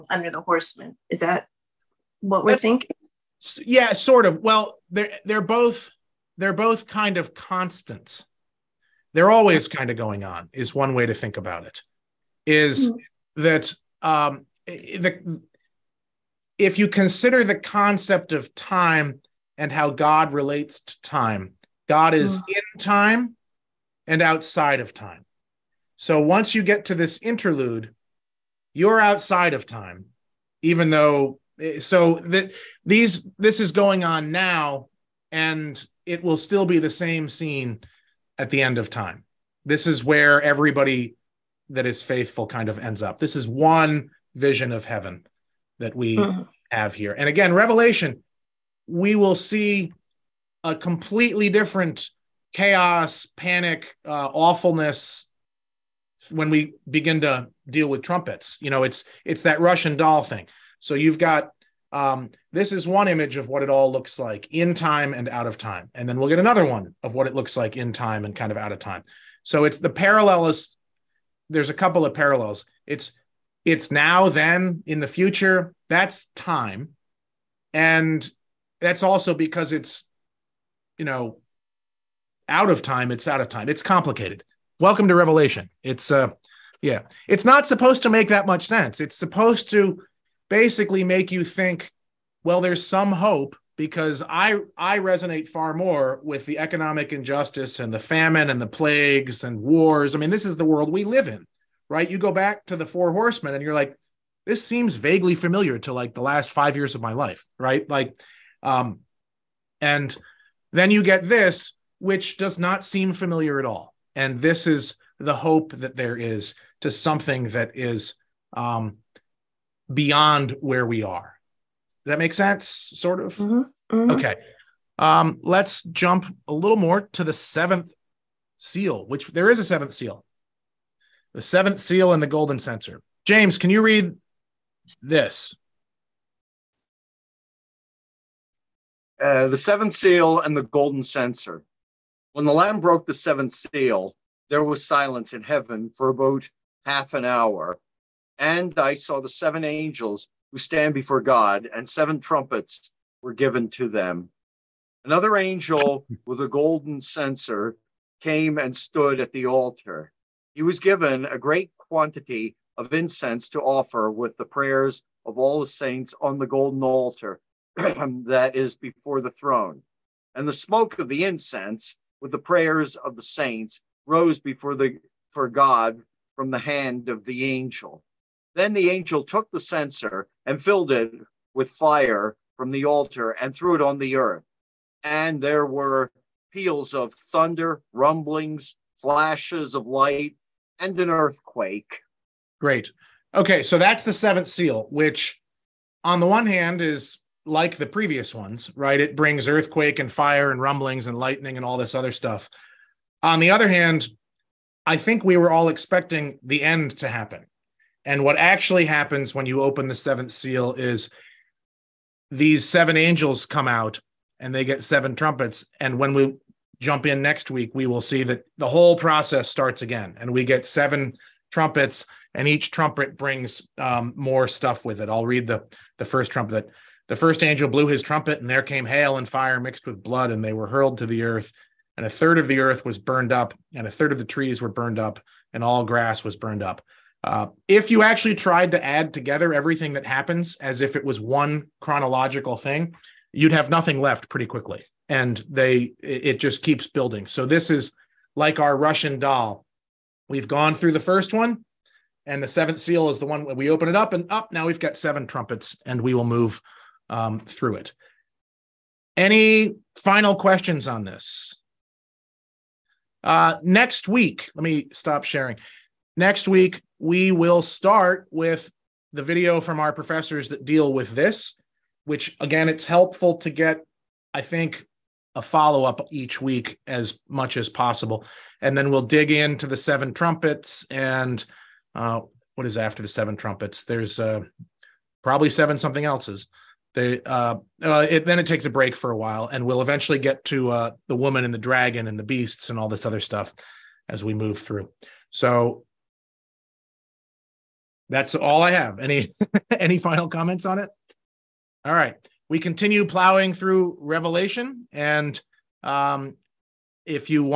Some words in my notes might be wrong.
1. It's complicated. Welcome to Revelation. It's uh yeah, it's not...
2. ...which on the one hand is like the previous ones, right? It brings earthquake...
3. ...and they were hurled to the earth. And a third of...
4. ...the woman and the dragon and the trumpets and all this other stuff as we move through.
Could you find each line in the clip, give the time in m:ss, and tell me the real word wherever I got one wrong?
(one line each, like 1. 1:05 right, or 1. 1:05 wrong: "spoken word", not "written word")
1. 1:23 right
2. 3:14 right
3. 3:50 right
4. 4:51 wrong: "beasts", not "trumpets".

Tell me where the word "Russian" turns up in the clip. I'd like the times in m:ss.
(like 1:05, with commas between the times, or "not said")
0:59, 4:08.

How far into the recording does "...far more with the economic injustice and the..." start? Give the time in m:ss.
1:35.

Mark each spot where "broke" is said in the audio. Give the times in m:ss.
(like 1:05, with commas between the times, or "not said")
2:22.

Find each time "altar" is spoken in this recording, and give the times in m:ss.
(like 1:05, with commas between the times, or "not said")
2:39, 2:46, 3:02.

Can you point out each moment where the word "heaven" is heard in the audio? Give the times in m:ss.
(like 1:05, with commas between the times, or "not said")
0:44, 2:25.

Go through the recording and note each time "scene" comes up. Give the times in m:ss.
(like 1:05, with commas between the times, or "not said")
0:37.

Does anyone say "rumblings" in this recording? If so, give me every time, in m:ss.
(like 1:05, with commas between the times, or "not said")
3:07, 3:20.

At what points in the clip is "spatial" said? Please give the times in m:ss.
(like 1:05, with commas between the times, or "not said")
not said.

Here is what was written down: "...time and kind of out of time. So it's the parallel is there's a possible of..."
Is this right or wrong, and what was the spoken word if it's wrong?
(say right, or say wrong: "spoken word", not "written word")
wrong: "couple", not "possible".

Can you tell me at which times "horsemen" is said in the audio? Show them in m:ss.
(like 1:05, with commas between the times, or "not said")
0:00, 1:43.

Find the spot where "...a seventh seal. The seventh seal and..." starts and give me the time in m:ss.
2:09.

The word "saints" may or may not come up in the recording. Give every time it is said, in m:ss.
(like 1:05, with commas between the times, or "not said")
2:45, 2:53.